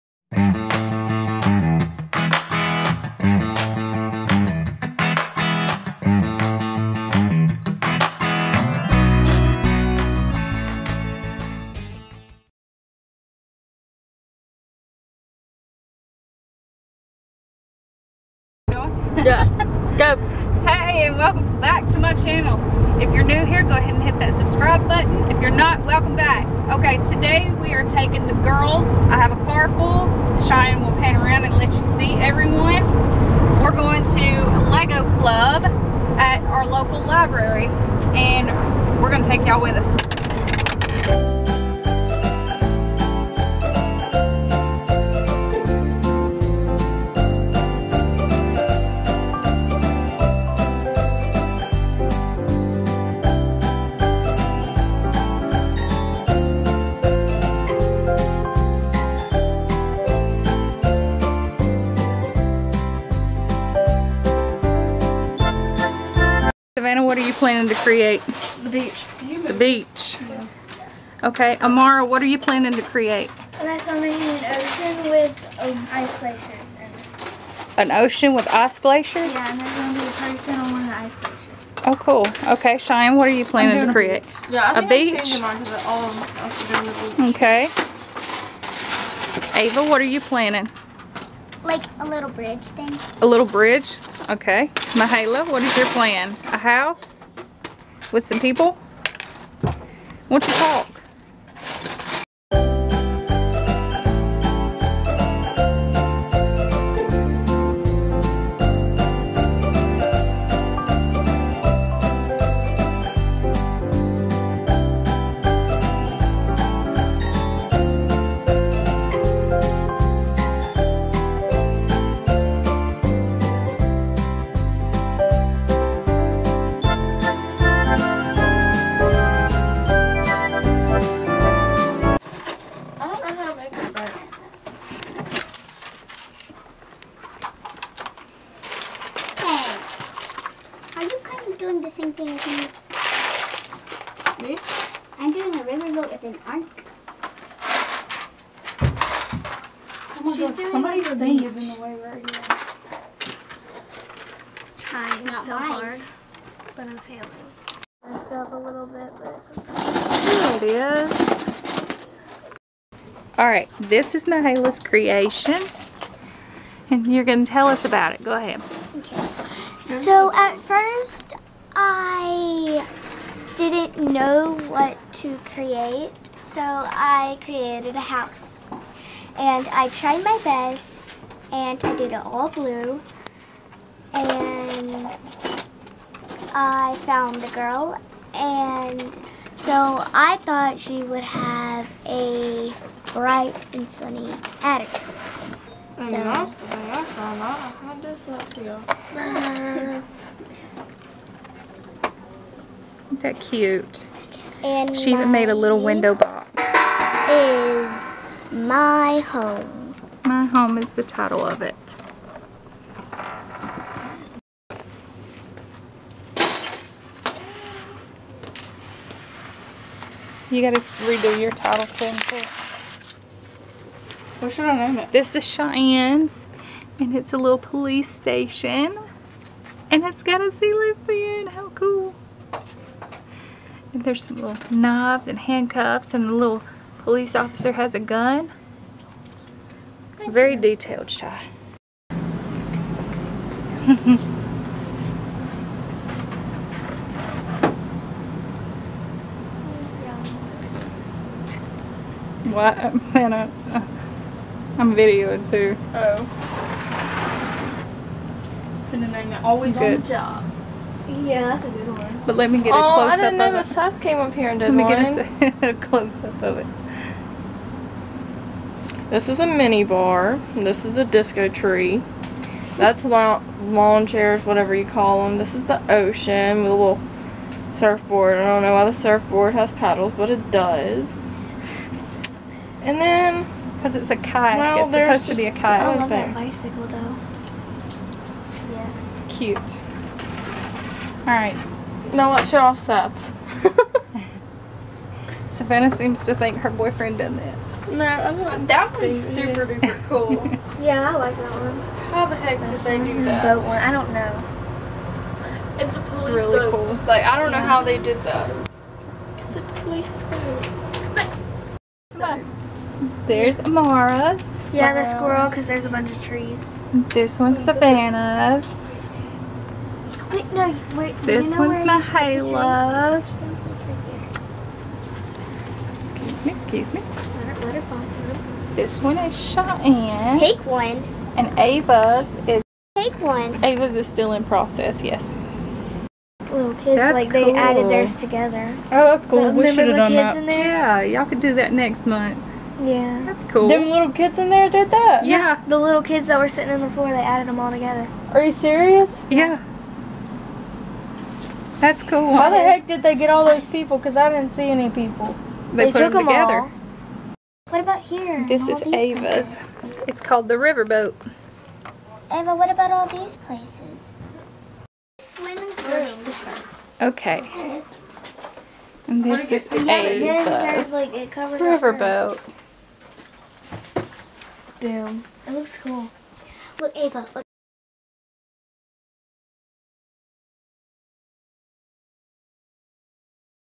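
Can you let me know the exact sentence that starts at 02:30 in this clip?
Oh my She's God, doing somebody's thing is in the way right here.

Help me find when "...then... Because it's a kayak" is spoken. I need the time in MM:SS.
04:43.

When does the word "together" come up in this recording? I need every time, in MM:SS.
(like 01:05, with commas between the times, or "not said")
05:38, 05:47, 05:56.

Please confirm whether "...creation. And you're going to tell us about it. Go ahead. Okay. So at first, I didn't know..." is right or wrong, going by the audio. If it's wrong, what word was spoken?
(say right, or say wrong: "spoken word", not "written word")
right.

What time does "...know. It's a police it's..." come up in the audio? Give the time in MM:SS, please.
05:04.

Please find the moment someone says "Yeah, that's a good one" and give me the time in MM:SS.
04:21.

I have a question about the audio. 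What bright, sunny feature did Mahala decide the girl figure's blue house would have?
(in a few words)
attic.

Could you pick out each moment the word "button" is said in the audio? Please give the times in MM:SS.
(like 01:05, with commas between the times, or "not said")
00:24.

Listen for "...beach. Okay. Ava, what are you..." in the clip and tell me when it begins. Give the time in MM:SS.
01:27.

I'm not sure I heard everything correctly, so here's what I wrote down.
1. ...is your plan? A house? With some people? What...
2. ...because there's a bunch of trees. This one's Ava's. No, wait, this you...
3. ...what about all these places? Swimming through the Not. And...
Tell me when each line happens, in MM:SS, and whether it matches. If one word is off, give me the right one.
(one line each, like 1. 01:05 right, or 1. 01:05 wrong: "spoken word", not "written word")
1. 01:35 right
2. 05:15 wrong: "Savannah", not "Ava"
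3. 06:02 wrong: "Okay", not "Not".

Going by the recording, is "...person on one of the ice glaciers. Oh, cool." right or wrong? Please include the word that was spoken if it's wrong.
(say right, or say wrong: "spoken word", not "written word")
right.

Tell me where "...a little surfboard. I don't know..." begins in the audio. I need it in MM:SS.
04:36.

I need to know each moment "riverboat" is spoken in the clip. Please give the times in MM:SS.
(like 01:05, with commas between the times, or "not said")
02:25, 06:00, 06:11.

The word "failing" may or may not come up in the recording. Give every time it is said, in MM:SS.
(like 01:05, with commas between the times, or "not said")
02:36.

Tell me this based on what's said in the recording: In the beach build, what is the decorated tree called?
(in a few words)
disco tree.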